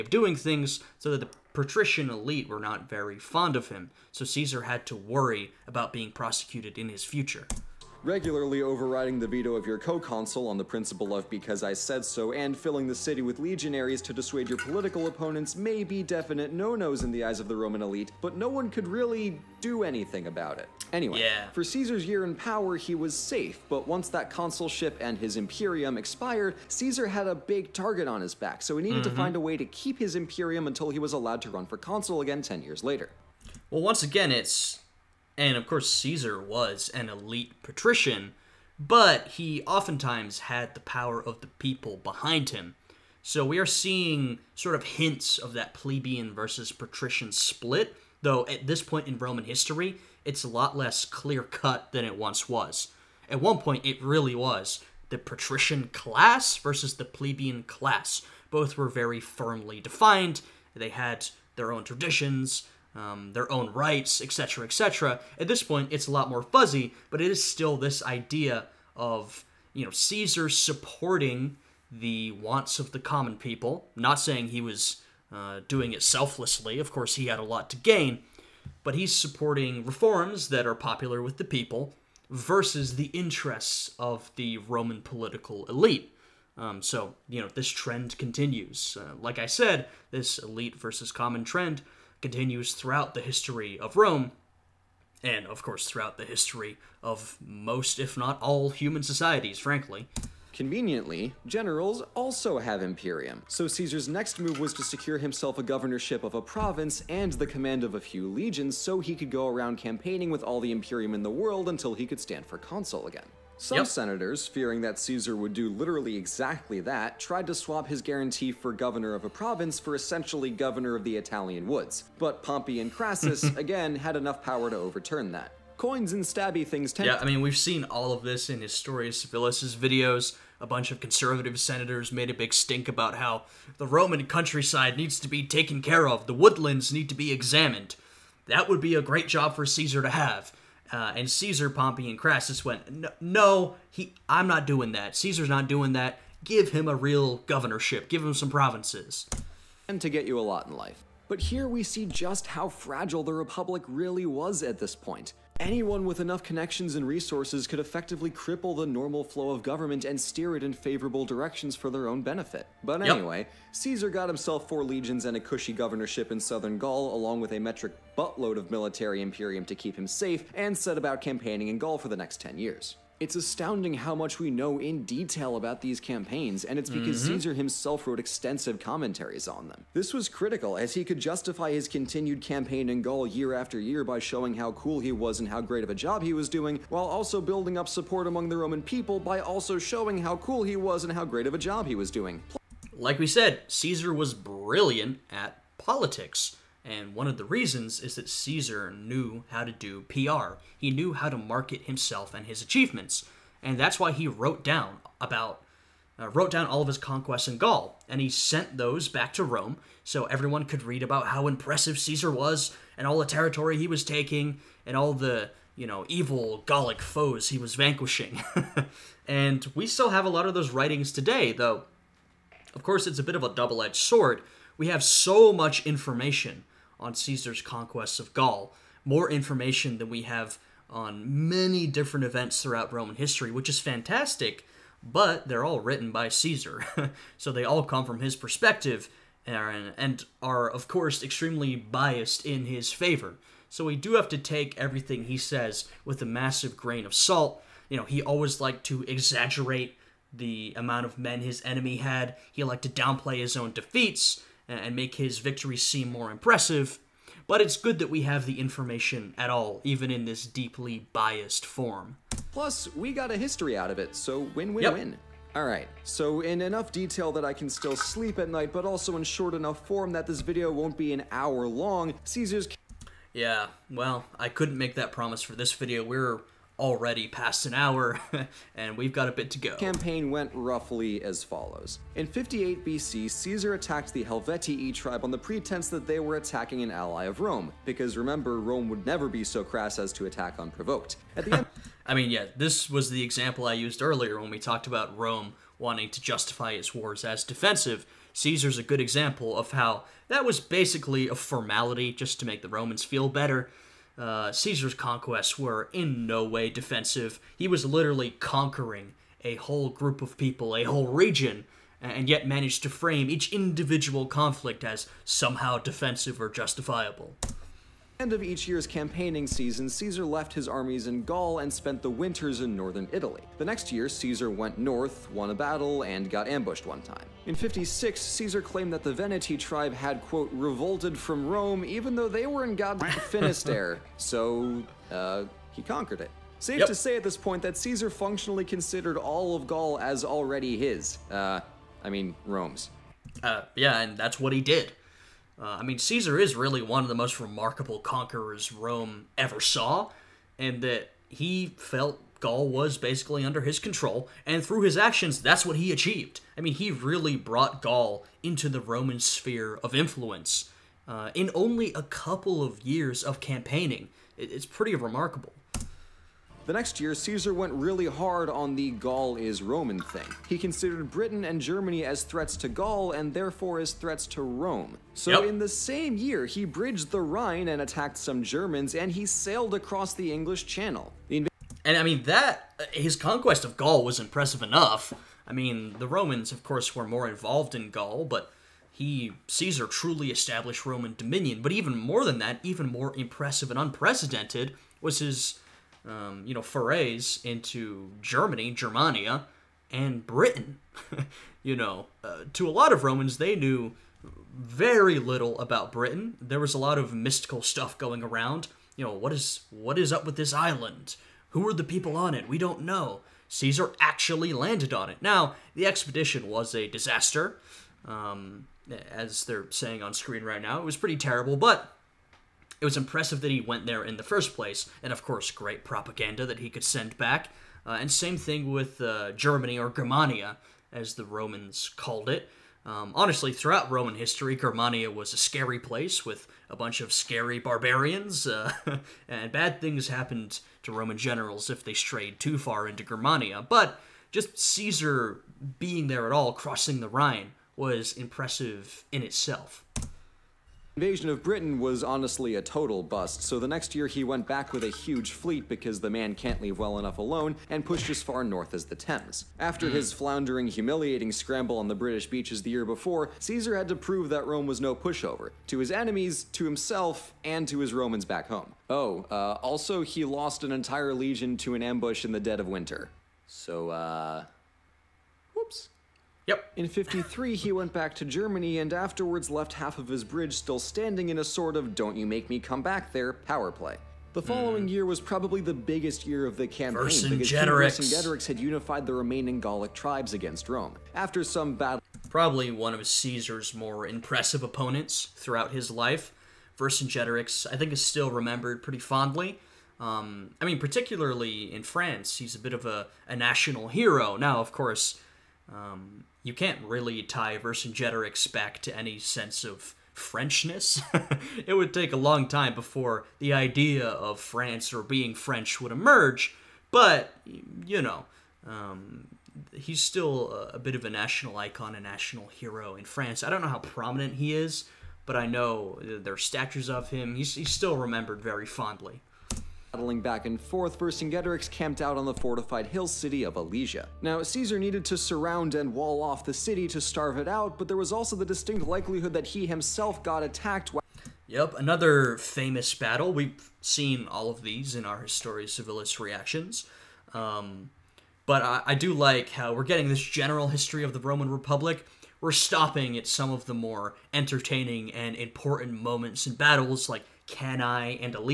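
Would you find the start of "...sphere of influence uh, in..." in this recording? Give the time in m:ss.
5:59.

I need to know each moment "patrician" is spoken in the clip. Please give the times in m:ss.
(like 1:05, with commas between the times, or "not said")
0:01, 0:37, 0:46, 0:55.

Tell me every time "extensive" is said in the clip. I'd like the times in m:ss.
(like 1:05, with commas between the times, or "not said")
2:58.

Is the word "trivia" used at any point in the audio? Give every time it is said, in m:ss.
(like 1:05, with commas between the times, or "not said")
not said.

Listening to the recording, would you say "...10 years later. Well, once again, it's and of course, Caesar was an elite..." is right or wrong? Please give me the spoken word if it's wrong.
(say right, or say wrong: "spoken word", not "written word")
right.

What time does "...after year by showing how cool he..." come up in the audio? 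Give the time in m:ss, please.
3:03.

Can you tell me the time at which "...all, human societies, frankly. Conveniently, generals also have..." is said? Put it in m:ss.
1:38.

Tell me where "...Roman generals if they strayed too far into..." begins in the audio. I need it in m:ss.
7:20.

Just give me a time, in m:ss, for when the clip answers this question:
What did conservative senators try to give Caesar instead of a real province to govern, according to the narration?
2:00.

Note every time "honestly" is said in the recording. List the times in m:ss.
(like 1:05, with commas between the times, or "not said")
7:13, 7:32.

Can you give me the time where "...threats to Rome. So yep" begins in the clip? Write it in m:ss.
6:13.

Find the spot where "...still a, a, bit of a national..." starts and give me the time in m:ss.
8:39.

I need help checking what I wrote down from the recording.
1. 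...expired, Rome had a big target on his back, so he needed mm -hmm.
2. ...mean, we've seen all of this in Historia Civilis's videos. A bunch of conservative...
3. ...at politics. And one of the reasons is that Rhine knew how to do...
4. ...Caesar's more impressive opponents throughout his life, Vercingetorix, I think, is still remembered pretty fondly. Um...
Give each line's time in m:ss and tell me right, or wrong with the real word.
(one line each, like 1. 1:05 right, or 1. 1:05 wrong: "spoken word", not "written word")
1. 0:25 wrong: "Caesar", not "Rome"
2. 2:07 right
3. 3:15 wrong: "Caesar", not "Rhine"
4. 8:13 right.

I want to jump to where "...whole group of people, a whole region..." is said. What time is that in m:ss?
5:09.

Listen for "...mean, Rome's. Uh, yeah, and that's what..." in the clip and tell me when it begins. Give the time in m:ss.
5:42.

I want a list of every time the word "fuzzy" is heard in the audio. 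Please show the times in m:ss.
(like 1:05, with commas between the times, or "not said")
1:06.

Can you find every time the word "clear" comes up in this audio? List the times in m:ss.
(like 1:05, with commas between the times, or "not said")
0:51.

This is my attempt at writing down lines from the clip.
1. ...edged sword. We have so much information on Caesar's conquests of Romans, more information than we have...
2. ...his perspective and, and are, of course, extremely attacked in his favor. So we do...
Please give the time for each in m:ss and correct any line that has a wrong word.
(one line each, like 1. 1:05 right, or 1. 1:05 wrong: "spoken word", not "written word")
1. 3:43 wrong: "Gaul", not "Romans"
2. 3:58 wrong: "biased", not "attacked".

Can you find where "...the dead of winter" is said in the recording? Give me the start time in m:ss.
7:52.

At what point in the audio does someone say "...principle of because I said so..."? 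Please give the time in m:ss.
0:10.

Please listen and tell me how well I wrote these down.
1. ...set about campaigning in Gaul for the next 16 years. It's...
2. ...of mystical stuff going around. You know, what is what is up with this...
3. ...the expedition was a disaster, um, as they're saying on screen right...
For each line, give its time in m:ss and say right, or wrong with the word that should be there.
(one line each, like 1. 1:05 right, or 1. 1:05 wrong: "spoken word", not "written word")
1. 2:50 wrong: "10", not "16"
2. 6:46 right
3. 6:55 right.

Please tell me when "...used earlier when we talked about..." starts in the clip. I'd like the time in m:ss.
4:53.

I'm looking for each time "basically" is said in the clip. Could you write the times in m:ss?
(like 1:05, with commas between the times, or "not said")
5:00, 5:52.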